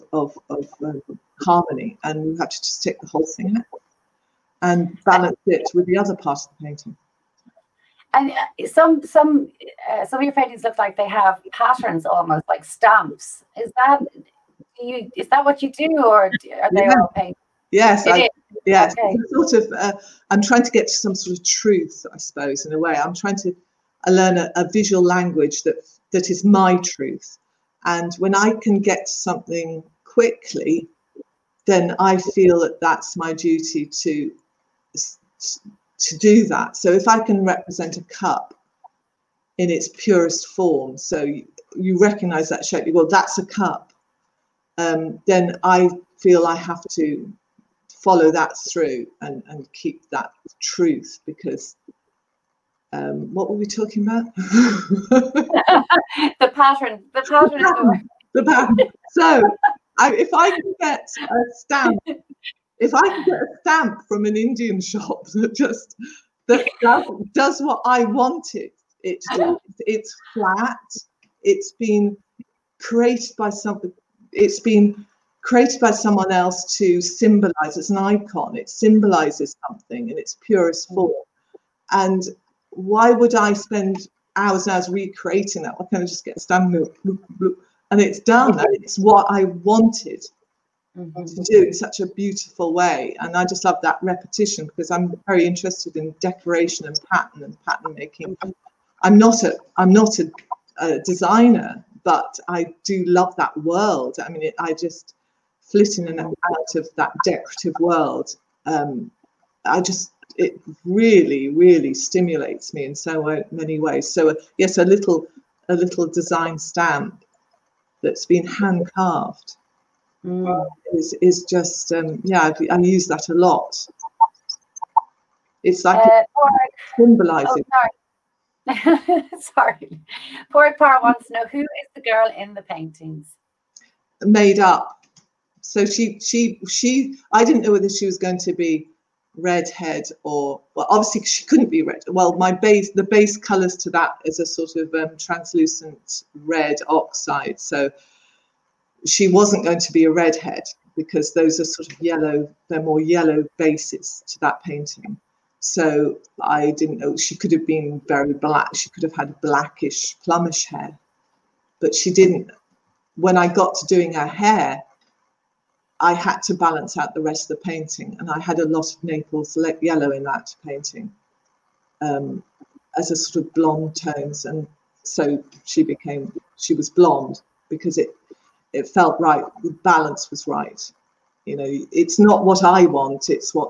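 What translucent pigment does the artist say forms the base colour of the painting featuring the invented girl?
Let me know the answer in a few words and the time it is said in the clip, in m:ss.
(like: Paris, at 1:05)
Red oxide, at 2:26.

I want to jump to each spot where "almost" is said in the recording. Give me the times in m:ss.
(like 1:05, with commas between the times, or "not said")
0:12.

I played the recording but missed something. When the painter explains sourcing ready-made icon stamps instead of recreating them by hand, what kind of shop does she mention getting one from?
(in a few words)
An Indian shop.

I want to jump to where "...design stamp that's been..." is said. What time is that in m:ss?
1:56.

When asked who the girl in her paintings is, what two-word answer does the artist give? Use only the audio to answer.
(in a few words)
Made up.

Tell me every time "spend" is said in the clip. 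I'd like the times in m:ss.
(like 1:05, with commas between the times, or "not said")
1:23.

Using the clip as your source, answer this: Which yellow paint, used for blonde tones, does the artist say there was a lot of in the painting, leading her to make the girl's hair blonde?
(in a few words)
Naples yellow.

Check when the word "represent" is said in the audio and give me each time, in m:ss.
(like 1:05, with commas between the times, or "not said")
0:37.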